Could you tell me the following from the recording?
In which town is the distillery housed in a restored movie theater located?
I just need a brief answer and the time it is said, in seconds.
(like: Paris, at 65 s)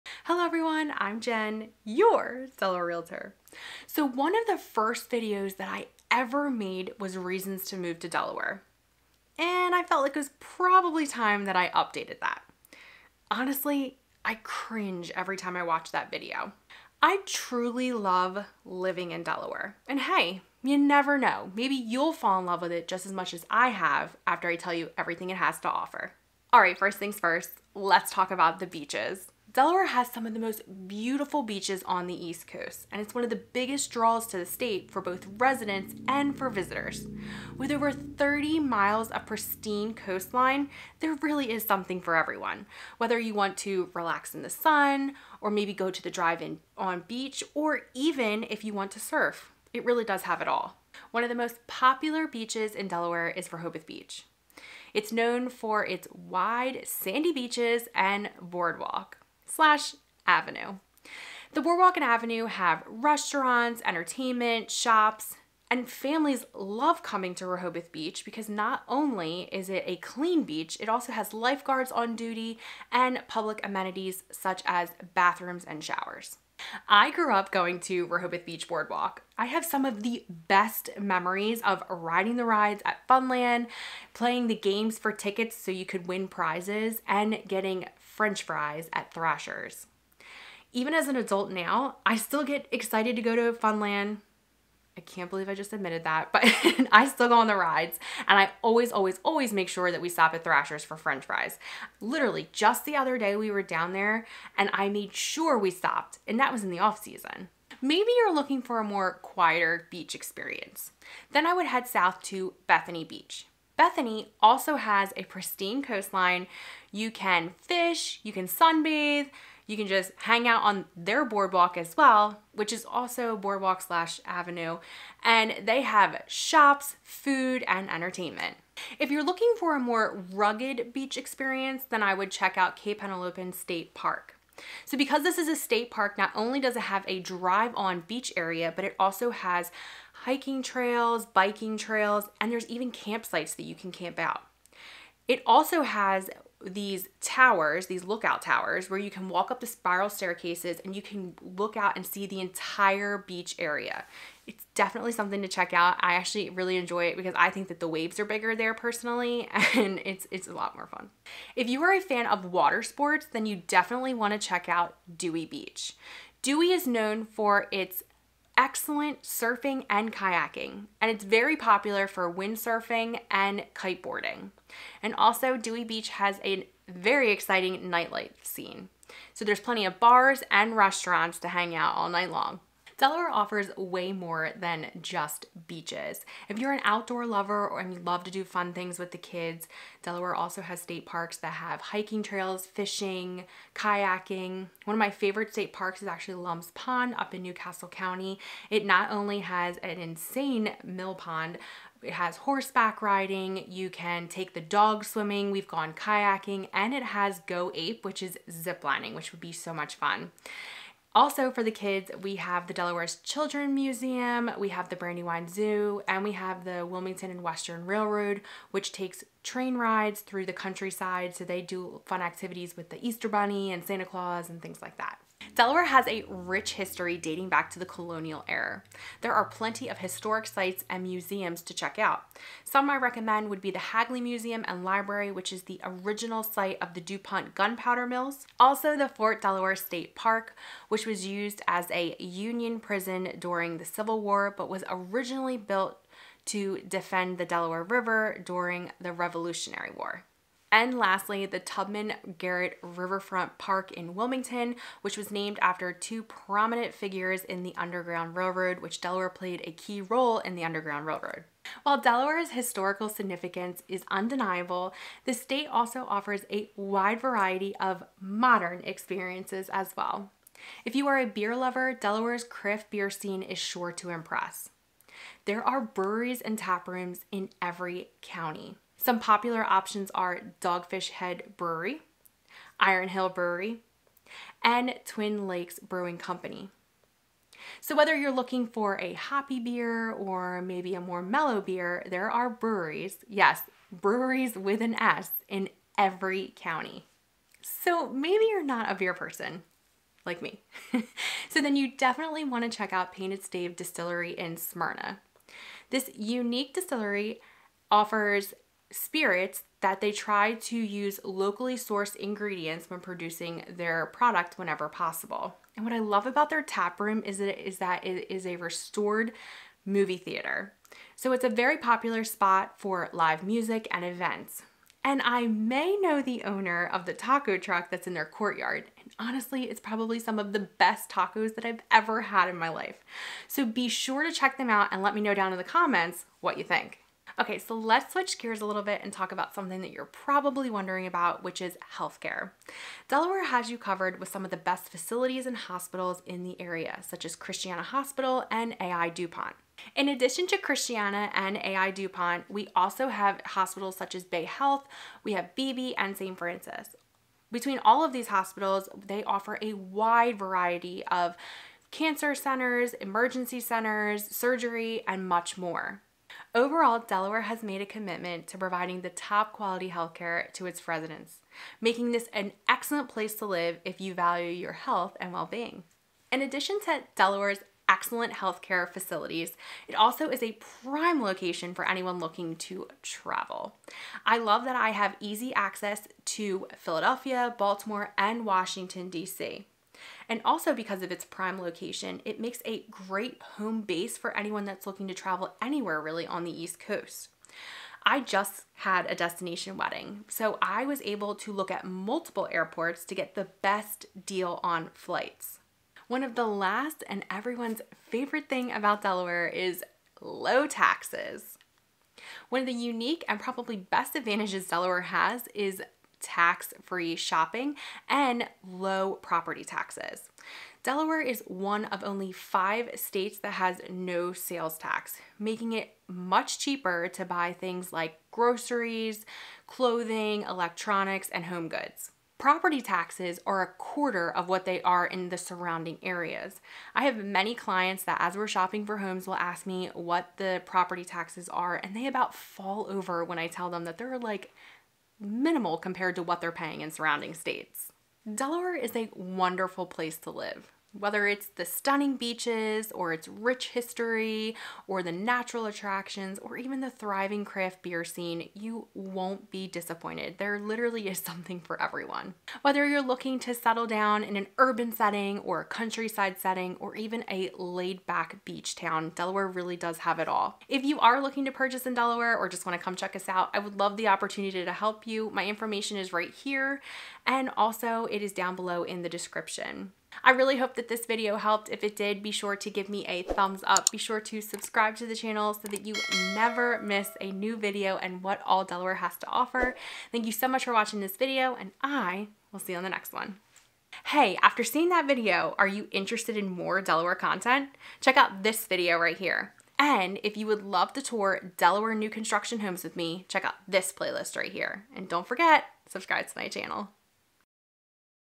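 Smyrna, at 304 s.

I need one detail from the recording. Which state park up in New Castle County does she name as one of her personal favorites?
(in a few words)
Lums Pond.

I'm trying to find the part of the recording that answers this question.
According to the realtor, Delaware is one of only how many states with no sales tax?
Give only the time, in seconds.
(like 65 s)
422 s.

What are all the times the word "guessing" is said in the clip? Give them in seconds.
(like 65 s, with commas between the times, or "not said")
not said.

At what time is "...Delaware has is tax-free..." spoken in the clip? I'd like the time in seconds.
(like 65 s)
414 s.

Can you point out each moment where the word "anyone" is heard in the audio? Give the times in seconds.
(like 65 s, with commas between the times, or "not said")
381 s, 394 s.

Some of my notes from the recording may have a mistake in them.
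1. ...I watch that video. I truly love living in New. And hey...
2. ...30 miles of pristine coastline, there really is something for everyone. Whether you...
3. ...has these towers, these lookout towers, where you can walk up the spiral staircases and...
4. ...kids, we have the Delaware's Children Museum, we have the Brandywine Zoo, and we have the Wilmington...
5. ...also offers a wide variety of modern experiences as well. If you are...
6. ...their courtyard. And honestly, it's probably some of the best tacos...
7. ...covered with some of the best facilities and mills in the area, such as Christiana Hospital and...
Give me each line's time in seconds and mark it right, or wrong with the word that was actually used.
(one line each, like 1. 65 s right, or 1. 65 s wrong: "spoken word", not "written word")
1. 15 s wrong: "Delaware", not "New"
2. 37 s right
3. 145 s right
4. 211 s right
5. 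265 s right
6. 328 s right
7. 343 s wrong: "hospitals", not "mills".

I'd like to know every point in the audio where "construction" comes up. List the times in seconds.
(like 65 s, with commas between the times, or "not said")
502 s.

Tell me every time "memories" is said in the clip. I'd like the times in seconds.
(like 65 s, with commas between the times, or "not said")
80 s.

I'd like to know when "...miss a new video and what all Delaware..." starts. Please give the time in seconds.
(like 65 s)
486 s.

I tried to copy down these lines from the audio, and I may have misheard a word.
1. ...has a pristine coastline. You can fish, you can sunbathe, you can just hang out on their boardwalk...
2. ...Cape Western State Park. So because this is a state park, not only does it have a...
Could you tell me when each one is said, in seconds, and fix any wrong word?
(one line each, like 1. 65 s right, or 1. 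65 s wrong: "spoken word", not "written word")
1. 114 s right
2. 132 s wrong: "Henlopen", not "Western".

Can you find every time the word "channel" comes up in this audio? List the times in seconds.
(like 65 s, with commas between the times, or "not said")
485 s, 506 s.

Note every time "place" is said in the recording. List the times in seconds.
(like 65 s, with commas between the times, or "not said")
373 s, 449 s.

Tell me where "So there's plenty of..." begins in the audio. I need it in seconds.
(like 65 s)
179 s.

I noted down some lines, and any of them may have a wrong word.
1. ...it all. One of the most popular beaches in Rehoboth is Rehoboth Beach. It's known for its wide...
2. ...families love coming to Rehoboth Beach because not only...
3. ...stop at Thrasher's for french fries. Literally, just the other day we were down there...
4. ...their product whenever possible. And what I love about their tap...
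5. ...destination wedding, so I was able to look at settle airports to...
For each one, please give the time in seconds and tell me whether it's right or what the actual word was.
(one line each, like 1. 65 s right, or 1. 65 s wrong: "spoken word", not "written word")
1. 50 s wrong: "Delaware", not "Rehoboth"
2. 65 s right
3. 100 s right
4. 313 s right
5. 399 s wrong: "multiple", not "settle".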